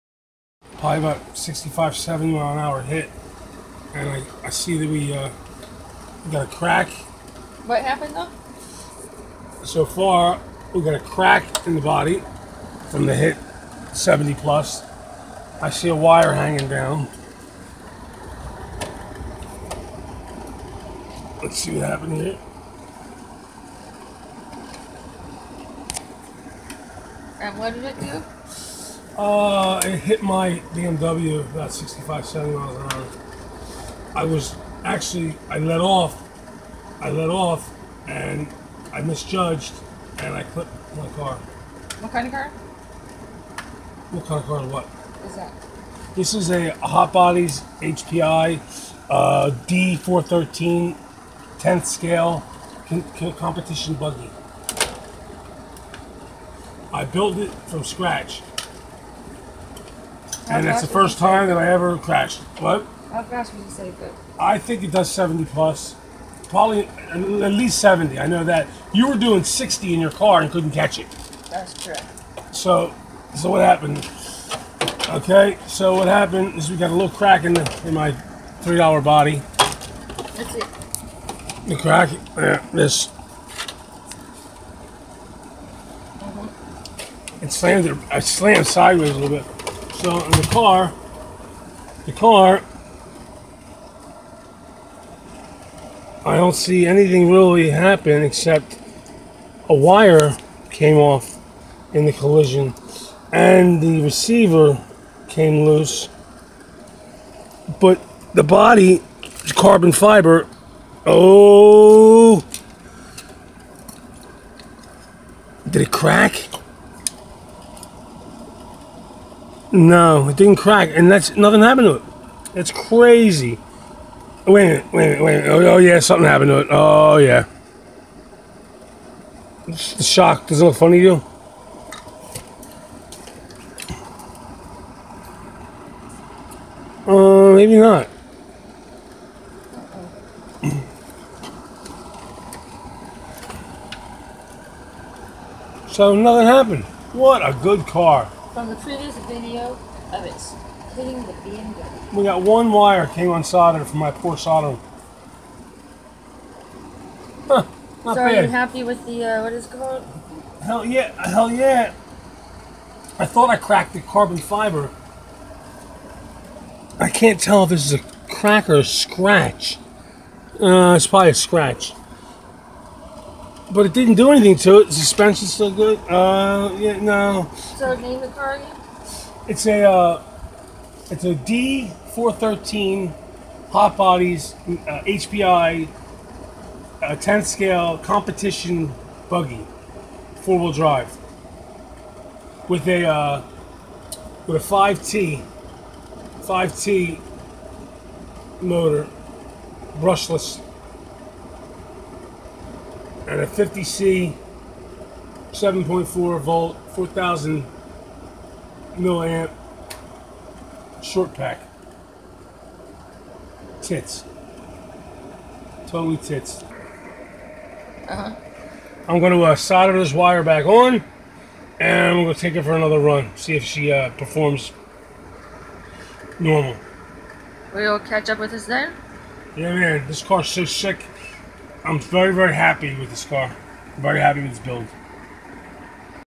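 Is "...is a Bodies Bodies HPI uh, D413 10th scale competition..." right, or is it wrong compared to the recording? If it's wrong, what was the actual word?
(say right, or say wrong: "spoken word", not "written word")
wrong: "Hot", not "Bodies".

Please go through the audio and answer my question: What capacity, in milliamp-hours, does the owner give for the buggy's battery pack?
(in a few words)
4,000 milliamp.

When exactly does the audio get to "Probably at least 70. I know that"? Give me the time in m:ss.
1:06.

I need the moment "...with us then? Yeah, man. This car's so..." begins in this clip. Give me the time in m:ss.
3:48.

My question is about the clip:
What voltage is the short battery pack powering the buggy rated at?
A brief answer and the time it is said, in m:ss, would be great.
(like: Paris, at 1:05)
7.4 volts, at 3:25.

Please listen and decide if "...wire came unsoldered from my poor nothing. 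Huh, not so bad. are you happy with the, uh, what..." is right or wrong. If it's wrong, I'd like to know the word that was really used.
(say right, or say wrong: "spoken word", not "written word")
wrong: "soldering", not "nothing".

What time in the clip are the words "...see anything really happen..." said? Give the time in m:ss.
1:36.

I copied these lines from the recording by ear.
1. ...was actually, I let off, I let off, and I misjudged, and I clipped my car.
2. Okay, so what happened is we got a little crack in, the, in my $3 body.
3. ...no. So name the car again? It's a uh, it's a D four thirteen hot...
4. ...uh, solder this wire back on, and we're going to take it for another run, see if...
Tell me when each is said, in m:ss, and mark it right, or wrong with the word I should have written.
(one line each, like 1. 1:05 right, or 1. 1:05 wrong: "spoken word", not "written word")
1. 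0:34 right
2. 1:15 right
3. 2:56 right
4. 3:39 right.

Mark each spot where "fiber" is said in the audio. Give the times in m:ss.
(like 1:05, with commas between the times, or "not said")
1:49, 2:44.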